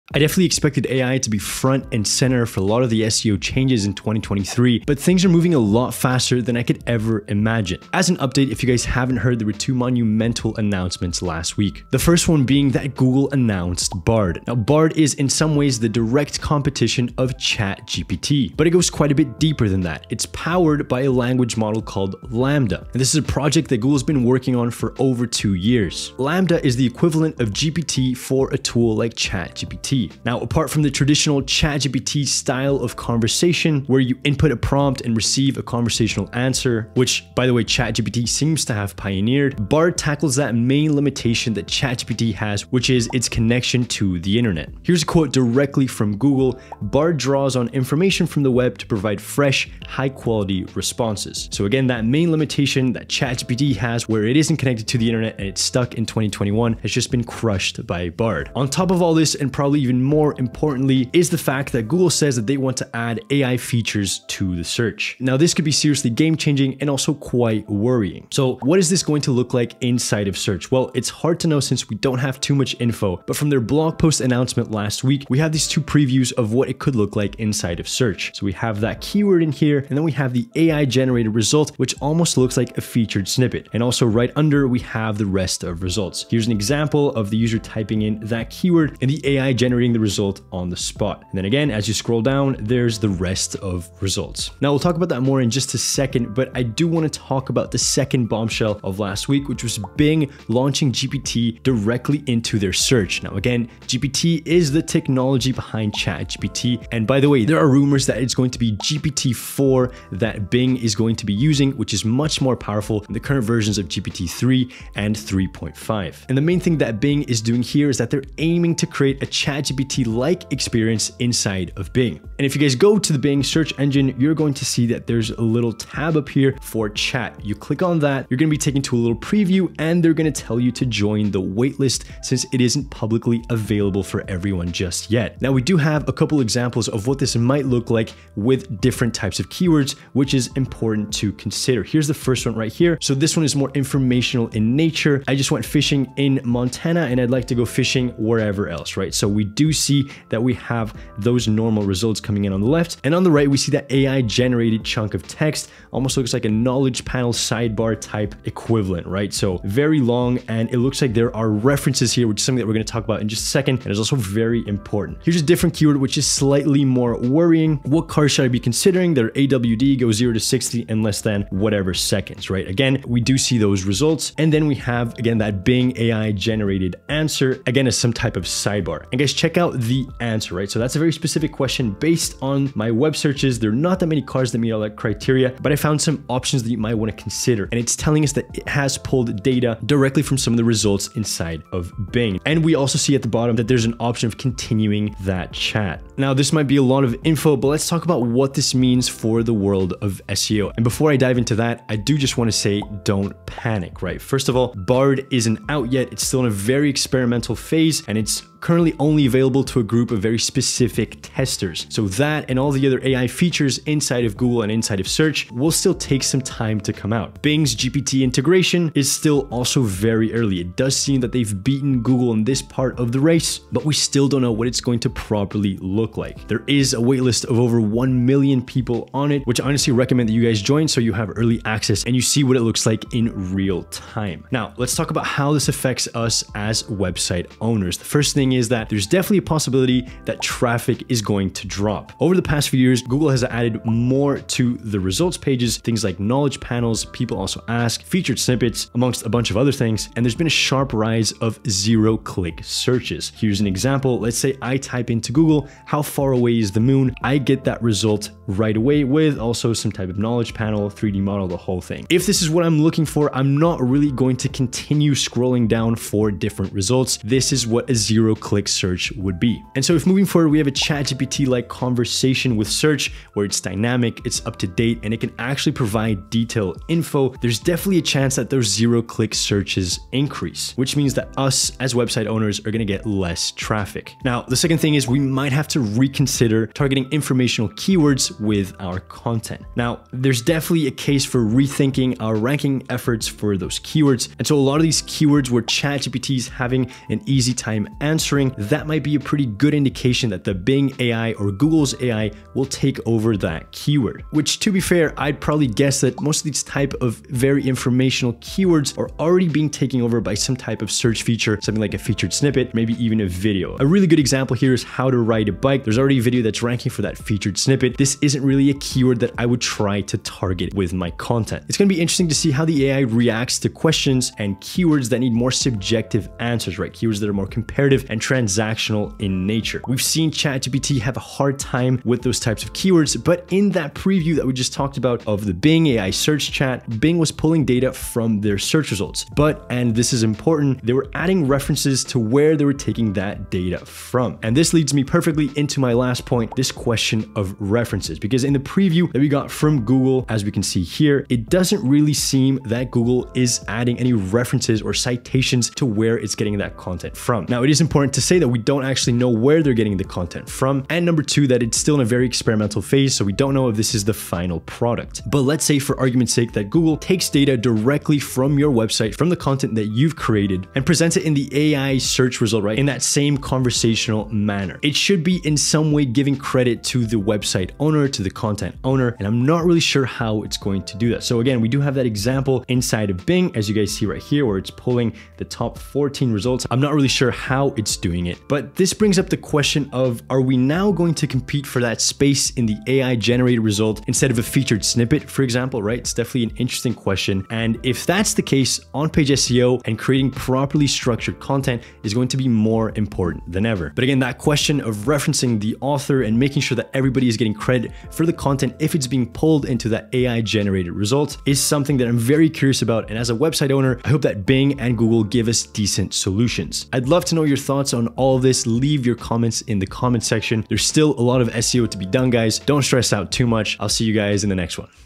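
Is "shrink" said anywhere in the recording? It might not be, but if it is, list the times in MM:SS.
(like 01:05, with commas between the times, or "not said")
not said.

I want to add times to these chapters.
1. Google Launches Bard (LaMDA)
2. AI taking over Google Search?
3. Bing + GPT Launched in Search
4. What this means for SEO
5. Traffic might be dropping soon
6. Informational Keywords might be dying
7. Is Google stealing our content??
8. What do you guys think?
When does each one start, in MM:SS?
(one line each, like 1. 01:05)
1. 00:14
2. 01:10
3. 01:40
4. 03:20
5. 04:00
6. 04:50
7. 05:45
8. 06:54.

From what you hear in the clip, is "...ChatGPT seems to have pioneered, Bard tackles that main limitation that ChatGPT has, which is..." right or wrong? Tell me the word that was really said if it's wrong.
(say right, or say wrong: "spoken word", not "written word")
right.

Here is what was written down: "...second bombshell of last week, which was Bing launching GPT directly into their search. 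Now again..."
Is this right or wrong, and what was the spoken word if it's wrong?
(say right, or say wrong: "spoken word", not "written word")
right.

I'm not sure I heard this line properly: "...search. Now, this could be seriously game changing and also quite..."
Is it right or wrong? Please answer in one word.
right.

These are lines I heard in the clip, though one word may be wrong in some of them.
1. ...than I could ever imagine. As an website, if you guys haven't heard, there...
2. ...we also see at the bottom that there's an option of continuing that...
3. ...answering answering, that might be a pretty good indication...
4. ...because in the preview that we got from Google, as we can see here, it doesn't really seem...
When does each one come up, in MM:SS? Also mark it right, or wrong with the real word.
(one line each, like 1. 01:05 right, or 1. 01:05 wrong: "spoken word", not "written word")
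1. 00:06 wrong: "update", not "website"
2. 03:12 right
3. 04:58 right
4. 05:48 right.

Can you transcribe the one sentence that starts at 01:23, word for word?
And also right under, we have the rest of results.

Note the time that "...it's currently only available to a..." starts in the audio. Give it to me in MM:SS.
03:28.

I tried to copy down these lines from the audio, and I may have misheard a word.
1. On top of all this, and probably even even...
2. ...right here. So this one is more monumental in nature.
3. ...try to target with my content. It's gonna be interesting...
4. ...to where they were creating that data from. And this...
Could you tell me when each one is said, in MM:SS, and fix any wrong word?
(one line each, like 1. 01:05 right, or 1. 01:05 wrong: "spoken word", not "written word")
1. 00:58 right
2. 02:22 wrong: "informational", not "monumental"
3. 05:19 right
4. 05:42 wrong: "taking", not "creating".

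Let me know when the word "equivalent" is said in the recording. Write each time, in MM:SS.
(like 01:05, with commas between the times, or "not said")
00:26, 02:38.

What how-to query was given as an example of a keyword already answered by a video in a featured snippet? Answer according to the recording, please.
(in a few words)
How to ride a bike.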